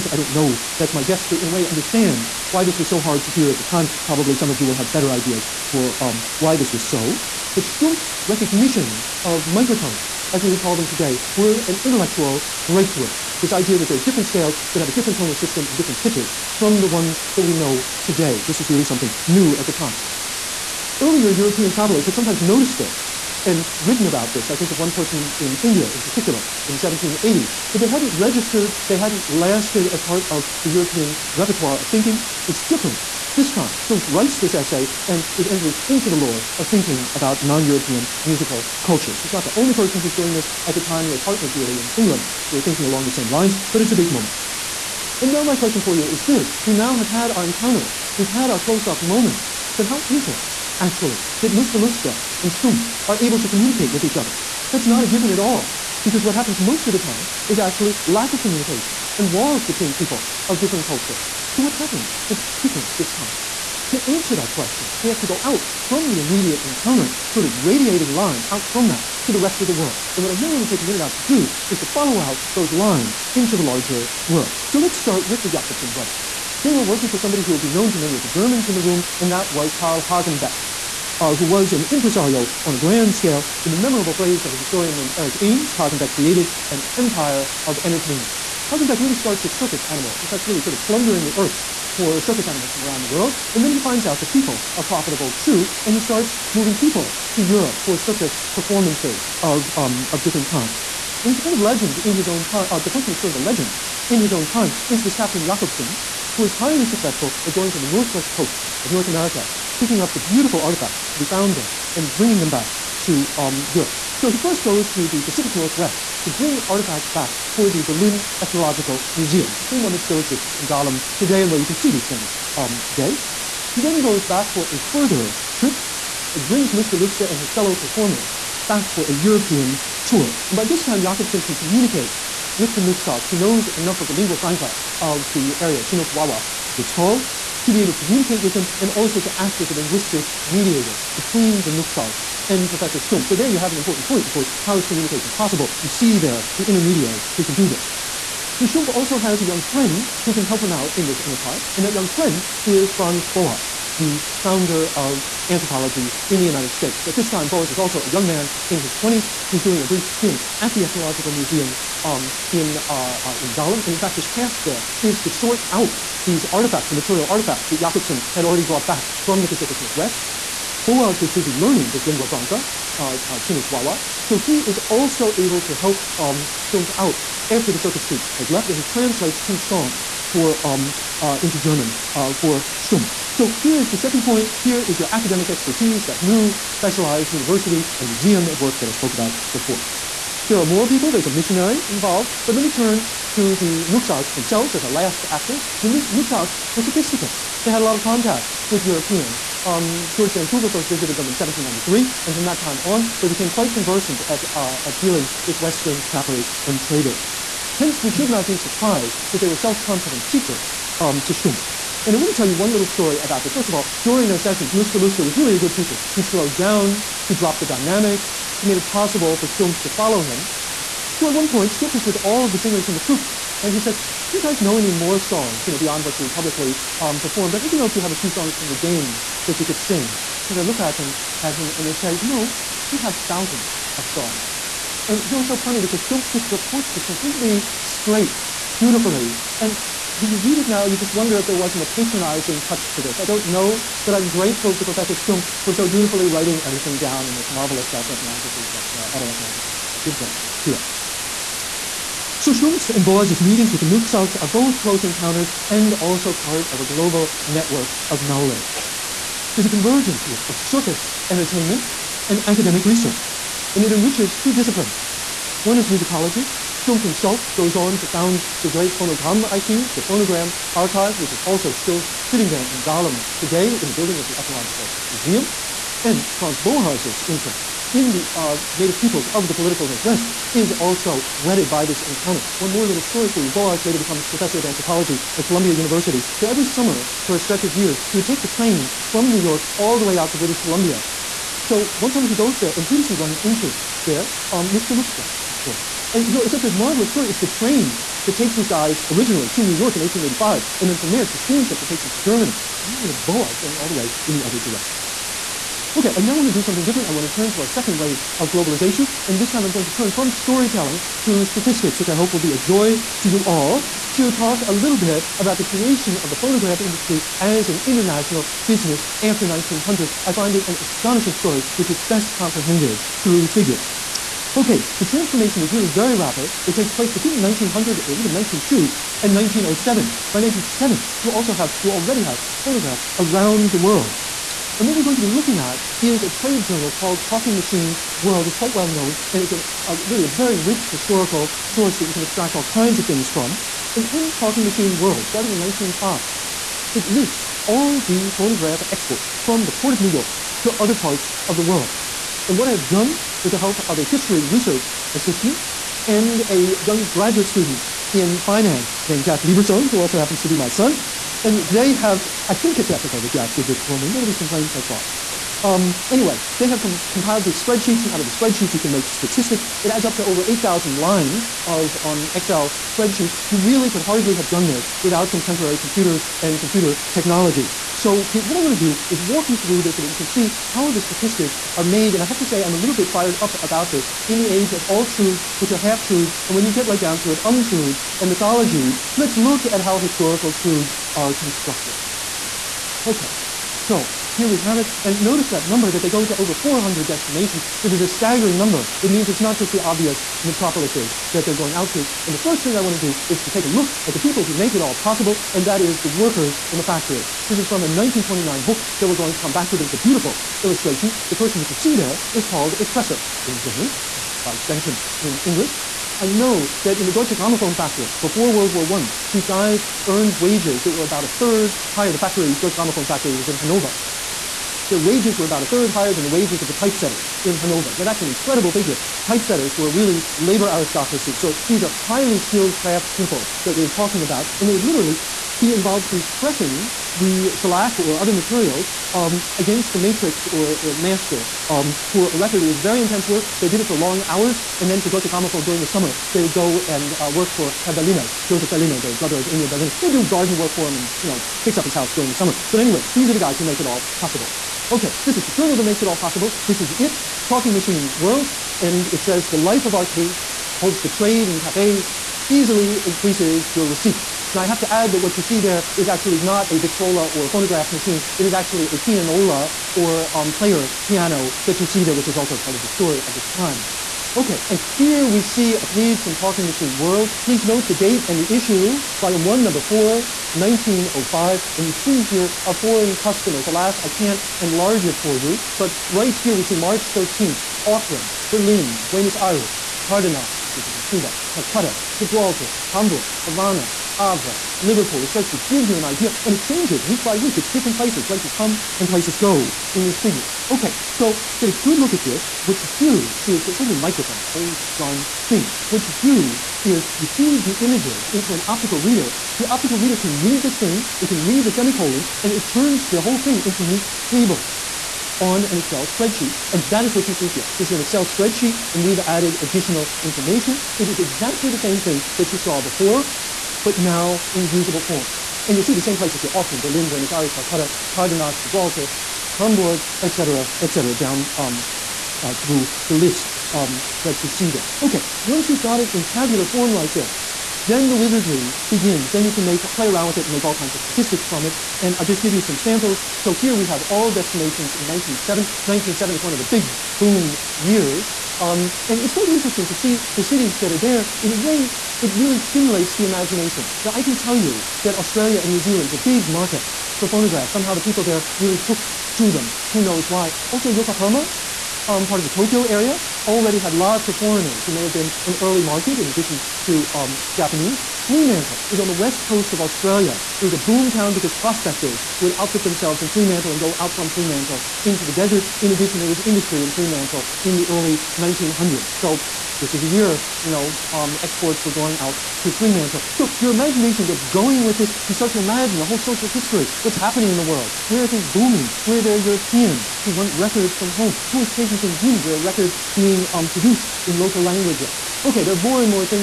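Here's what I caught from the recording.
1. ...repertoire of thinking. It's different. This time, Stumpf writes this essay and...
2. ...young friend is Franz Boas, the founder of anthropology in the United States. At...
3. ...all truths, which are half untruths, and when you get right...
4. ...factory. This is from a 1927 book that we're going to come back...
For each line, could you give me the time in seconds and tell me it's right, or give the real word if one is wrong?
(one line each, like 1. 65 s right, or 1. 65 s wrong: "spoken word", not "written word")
1. 31 s right
2. 151 s right
3. 384 s wrong: "truths", not "untruths"
4. 406 s wrong: "1929", not "1927".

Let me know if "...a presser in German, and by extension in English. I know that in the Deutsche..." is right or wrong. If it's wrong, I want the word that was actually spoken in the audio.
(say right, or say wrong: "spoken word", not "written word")
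right.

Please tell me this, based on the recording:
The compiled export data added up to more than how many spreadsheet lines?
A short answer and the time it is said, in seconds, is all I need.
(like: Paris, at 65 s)
8,000, at 370 s.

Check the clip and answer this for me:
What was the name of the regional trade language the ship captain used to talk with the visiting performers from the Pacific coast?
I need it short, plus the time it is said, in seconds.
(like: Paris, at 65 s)
Chinook Wawa, at 135 s.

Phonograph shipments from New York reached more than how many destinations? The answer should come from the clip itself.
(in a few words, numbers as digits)
400.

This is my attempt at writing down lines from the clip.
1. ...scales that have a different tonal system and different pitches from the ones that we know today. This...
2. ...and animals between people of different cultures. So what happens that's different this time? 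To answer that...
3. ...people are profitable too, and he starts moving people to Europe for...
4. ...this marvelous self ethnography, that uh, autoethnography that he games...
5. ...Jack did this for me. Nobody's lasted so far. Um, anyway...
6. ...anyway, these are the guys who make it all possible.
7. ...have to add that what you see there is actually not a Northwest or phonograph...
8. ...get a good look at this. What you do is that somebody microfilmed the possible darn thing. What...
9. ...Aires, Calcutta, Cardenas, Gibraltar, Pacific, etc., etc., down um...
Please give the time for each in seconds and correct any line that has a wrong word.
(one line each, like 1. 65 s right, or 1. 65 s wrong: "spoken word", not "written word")
1. 14 s right
2. 59 s wrong: "walls", not "animals"
3. 94 s right
4. 247 s wrong: "gives", not "games"
5. 363 s wrong: "complained", not "lasted"
6. 452 s right
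7. 464 s wrong: "Victrola", not "Northwest"
8. 501 s wrong: "whole", not "possible"
9. 527 s wrong: "Hamburg", not "Pacific".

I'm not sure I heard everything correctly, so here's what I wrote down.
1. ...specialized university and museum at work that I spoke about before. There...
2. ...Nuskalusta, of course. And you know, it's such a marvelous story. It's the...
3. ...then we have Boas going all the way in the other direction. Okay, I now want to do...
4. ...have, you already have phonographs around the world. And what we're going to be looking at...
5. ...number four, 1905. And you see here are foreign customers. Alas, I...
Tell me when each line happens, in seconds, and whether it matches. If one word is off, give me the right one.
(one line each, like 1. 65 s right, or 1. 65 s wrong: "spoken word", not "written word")
1. 186 s right
2. 294 s right
3. 302 s right
4. 331 s right
5. 479 s right.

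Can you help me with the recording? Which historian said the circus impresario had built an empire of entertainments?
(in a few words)
Eric Ames.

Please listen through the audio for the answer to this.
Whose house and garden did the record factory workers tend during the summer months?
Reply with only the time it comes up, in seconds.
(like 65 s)
448 s.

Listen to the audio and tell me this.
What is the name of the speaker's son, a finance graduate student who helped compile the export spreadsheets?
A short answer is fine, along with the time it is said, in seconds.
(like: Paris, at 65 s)
Jack Liebersohn, at 359 s.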